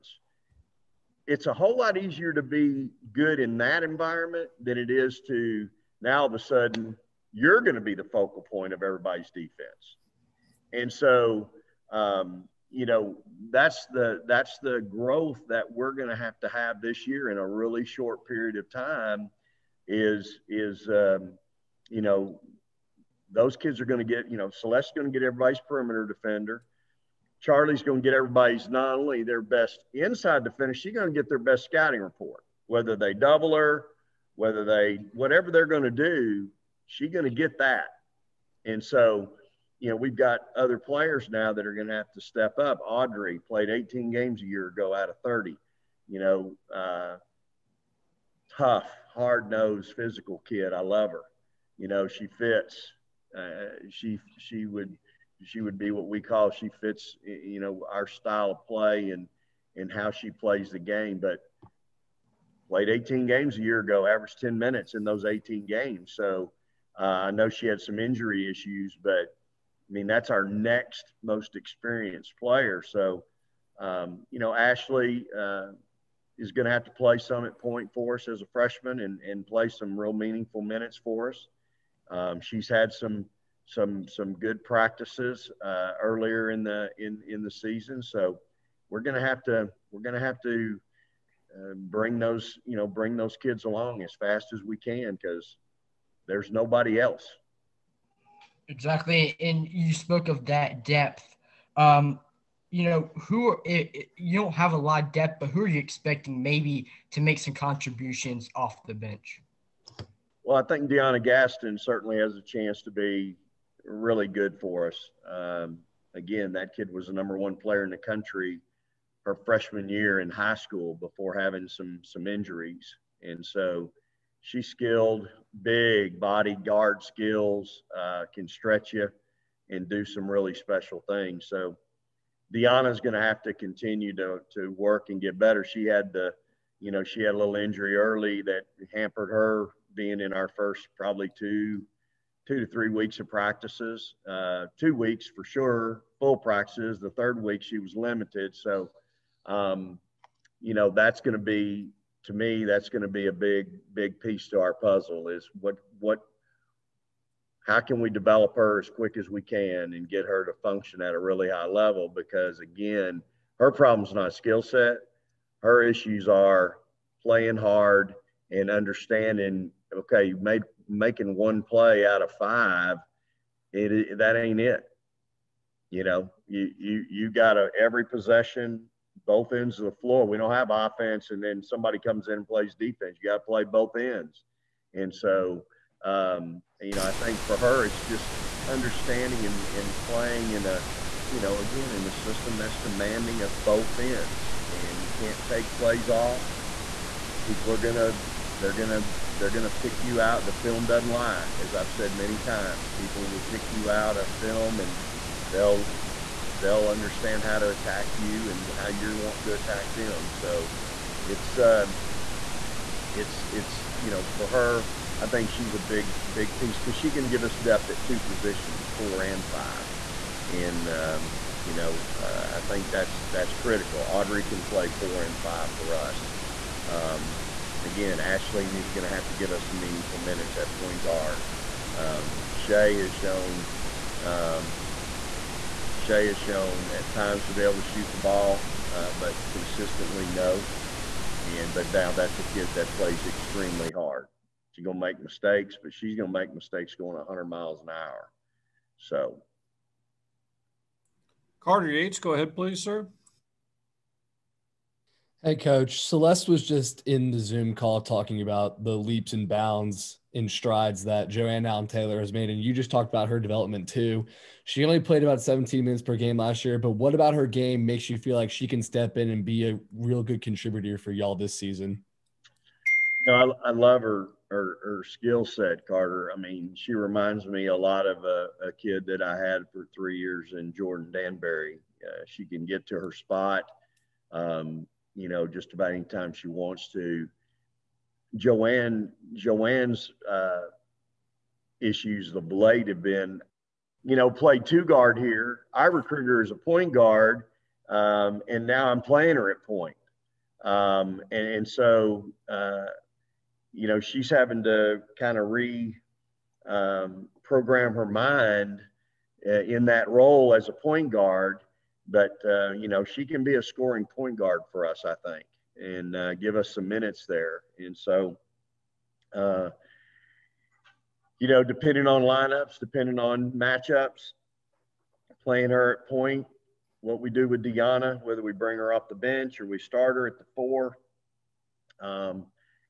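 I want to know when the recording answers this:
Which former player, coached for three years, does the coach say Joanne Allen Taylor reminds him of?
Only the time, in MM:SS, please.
04:40.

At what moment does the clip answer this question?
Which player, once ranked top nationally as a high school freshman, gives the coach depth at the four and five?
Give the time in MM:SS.
01:50.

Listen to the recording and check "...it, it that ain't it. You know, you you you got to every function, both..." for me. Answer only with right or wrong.
wrong.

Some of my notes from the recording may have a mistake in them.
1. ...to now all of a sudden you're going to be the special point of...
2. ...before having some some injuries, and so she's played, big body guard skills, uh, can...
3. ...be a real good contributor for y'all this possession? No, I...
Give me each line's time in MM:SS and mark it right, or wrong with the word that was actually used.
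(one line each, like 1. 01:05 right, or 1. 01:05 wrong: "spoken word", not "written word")
1. 00:05 wrong: "focal", not "special"
2. 02:00 wrong: "skilled", not "played"
3. 04:29 wrong: "season", not "possession".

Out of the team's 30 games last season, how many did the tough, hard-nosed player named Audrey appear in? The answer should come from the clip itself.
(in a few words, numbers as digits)
18.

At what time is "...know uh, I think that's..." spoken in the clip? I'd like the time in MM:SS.
03:41.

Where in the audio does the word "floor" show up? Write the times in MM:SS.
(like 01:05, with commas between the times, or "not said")
03:00.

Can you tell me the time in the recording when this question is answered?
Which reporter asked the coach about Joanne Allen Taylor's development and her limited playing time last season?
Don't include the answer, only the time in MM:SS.
04:11.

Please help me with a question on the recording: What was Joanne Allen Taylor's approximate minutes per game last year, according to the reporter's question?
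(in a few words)
17.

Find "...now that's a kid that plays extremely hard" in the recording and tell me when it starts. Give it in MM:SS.
04:01.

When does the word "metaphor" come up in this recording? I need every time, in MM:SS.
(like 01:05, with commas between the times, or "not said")
not said.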